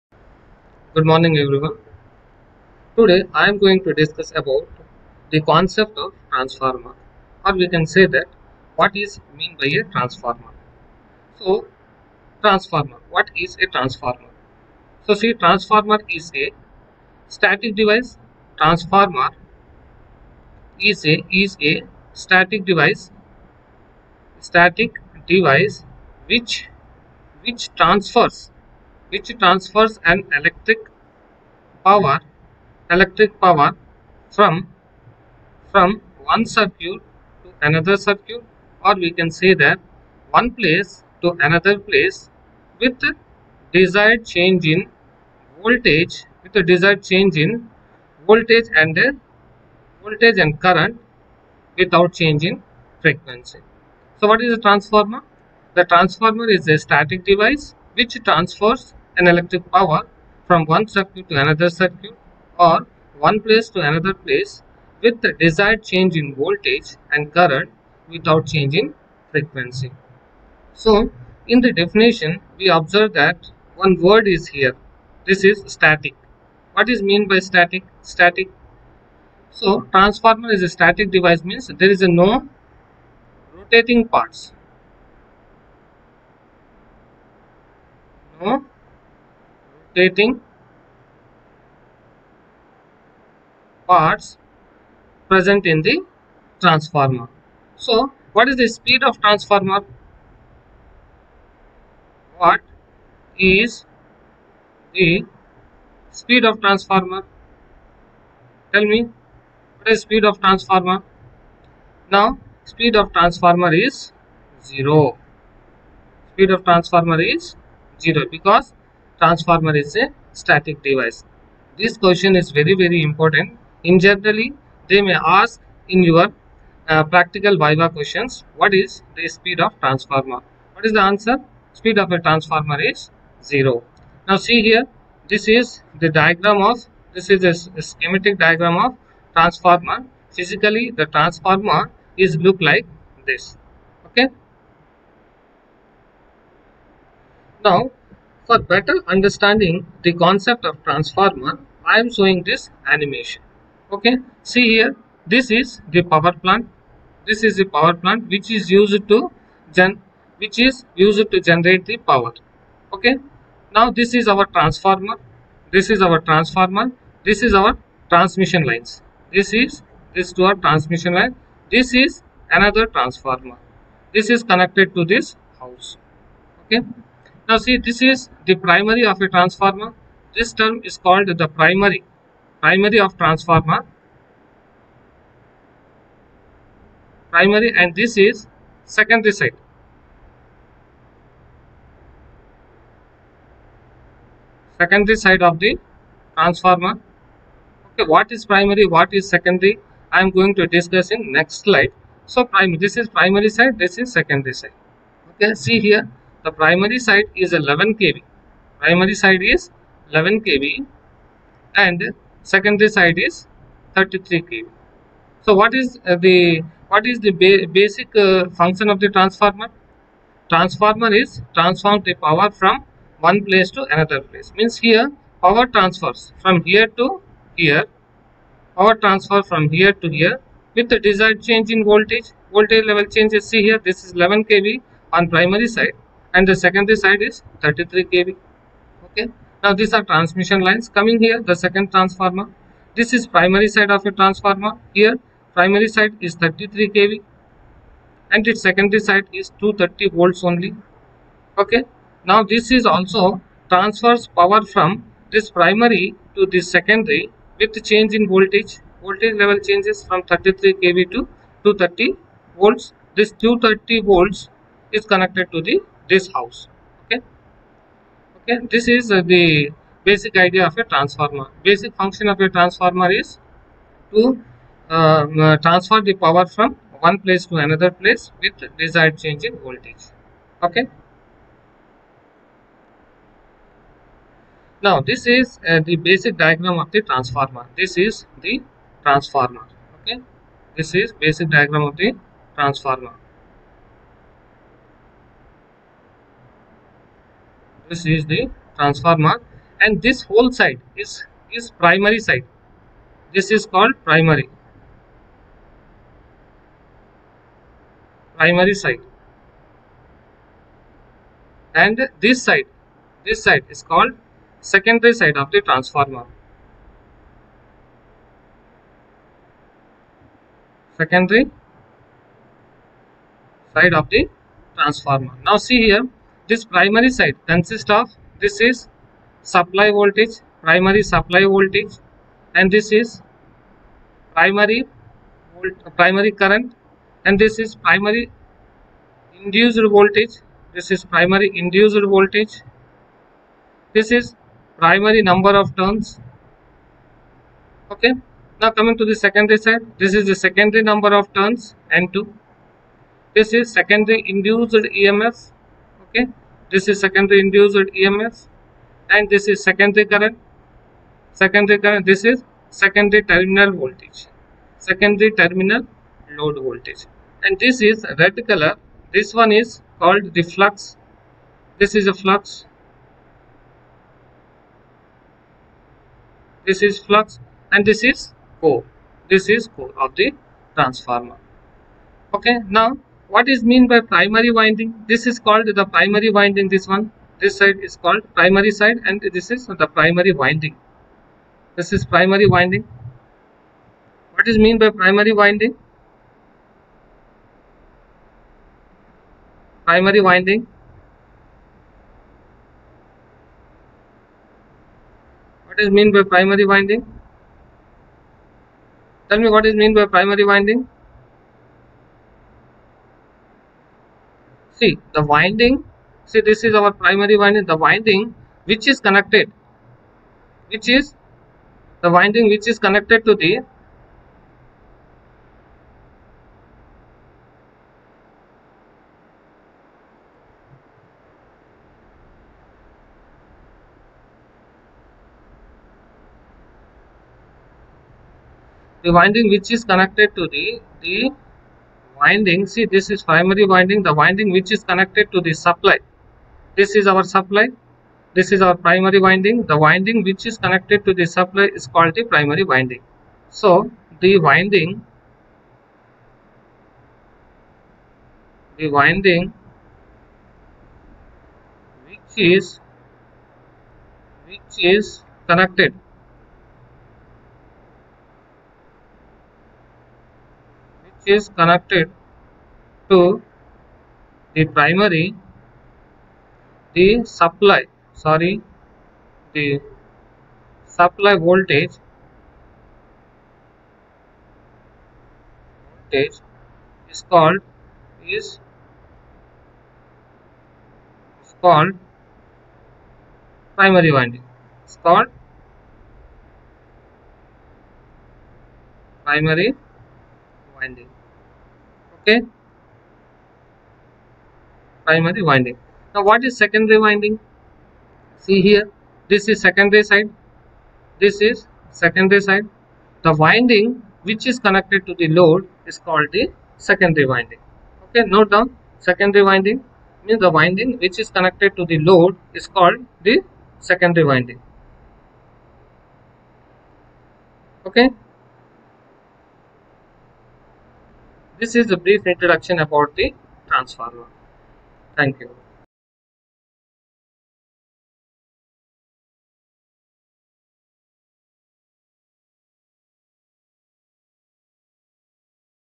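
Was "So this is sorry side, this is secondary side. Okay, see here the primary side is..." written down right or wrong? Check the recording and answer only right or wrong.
wrong.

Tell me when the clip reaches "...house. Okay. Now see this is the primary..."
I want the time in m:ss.
2:55.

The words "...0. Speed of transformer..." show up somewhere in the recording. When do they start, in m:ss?
1:54.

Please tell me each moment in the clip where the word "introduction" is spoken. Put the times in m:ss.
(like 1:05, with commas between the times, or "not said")
8:52.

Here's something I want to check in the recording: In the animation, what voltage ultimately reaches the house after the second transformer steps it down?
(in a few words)
230 volts.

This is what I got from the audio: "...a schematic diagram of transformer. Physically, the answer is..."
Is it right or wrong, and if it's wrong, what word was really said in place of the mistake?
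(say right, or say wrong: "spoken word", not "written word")
wrong: "transformer", not "answer".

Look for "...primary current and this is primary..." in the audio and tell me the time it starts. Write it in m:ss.
5:35.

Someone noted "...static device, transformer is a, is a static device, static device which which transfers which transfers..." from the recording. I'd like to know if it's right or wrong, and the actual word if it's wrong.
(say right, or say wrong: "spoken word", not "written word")
right.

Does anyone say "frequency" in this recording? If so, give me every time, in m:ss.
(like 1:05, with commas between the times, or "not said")
0:53, 1:09.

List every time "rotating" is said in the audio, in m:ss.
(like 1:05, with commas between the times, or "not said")
1:23, 1:29.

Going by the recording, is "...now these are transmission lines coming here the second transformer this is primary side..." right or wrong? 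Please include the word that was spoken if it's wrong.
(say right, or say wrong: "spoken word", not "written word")
right.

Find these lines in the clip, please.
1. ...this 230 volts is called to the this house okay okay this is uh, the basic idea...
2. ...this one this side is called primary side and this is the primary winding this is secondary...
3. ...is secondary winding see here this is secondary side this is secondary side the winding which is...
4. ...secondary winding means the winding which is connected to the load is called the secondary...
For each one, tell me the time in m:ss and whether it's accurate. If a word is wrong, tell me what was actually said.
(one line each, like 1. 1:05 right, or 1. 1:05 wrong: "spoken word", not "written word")
1. 4:23 wrong: "connected", not "called"
2. 6:26 wrong: "primary", not "secondary"
3. 8:26 right
4. 8:39 right.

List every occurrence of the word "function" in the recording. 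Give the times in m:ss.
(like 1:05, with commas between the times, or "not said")
3:38, 4:32.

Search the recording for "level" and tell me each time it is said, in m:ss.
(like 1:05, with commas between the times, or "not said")
3:52, 4:19.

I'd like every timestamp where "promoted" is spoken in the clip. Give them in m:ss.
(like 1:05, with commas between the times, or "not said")
not said.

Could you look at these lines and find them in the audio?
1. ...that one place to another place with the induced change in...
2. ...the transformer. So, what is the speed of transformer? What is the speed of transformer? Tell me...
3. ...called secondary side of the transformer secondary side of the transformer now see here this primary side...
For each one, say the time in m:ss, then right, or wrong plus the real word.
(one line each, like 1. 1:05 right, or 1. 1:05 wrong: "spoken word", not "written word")
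1. 0:39 wrong: "desired", not "induced"
2. 1:35 right
3. 5:13 right.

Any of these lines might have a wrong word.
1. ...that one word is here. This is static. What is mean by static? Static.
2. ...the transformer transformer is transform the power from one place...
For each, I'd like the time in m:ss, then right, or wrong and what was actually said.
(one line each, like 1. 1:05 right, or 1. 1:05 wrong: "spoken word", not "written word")
1. 1:13 right
2. 3:39 right.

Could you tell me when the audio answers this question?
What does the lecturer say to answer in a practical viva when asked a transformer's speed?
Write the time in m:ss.
2:11.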